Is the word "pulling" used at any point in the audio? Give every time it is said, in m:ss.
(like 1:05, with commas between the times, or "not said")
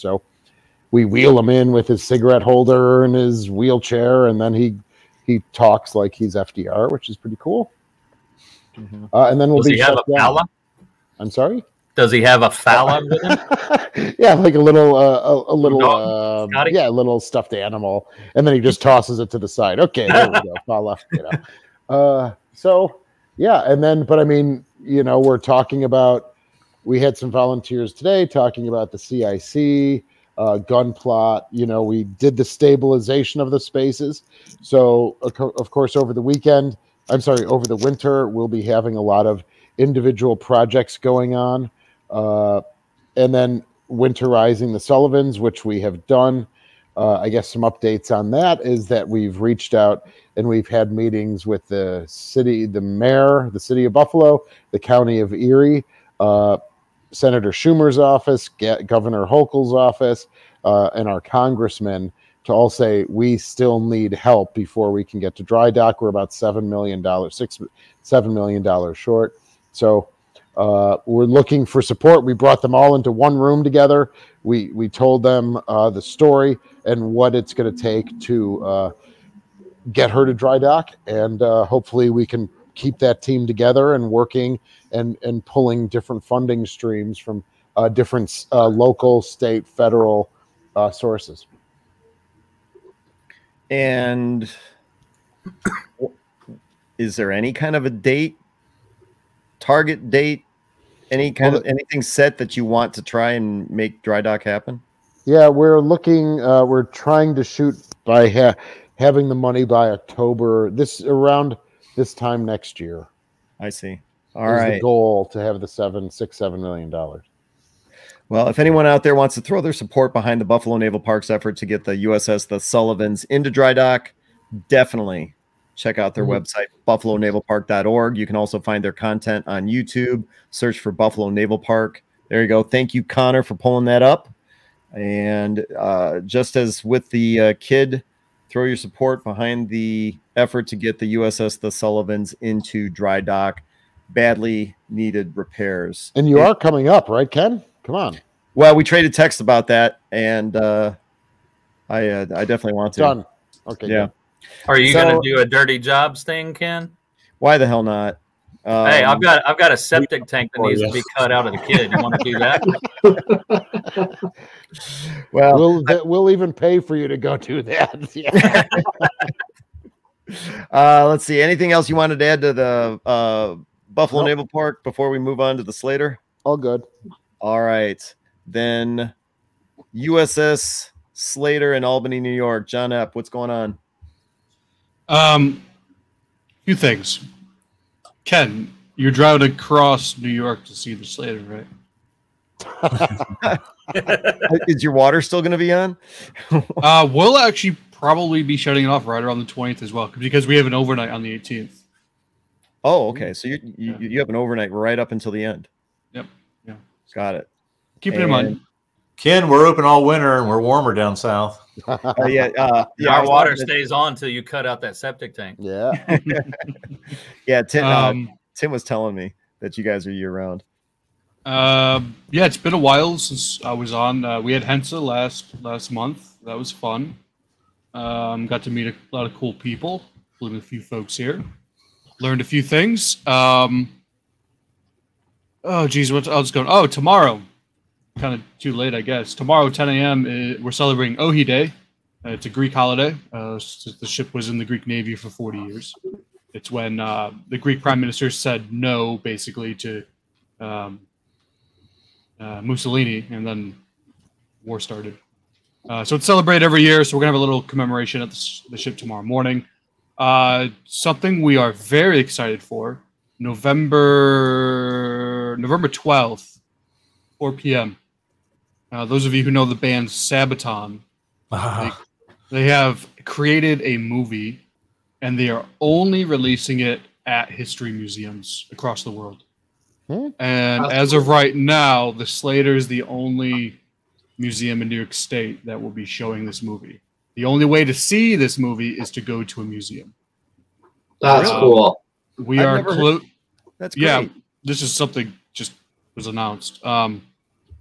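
1:25, 2:13.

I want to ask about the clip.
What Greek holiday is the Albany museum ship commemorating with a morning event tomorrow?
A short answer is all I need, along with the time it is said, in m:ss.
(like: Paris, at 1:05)
Ohi Day, at 4:01.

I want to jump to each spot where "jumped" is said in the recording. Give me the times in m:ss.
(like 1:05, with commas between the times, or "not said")
not said.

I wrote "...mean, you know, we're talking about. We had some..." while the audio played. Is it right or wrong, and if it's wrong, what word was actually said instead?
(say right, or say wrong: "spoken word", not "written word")
right.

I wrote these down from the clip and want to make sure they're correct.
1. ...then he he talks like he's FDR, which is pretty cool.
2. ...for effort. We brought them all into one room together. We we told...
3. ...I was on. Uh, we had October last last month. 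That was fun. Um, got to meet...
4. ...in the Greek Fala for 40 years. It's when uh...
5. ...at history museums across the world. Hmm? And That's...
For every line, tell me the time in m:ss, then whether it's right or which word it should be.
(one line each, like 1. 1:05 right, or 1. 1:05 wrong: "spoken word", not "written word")
1. 0:04 right
2. 1:11 wrong: "support", not "effort"
3. 3:43 wrong: "Hensa", not "October"
4. 4:04 wrong: "Navy", not "Fala"
5. 4:37 right.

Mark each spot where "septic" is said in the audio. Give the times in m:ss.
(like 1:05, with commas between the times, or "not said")
2:39, 3:34.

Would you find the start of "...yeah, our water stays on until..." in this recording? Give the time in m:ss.
3:32.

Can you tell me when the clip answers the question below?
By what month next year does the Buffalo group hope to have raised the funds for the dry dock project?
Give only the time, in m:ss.
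1:49.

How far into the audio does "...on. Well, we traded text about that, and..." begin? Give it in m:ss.
2:27.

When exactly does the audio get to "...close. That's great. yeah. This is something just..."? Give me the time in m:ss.
4:52.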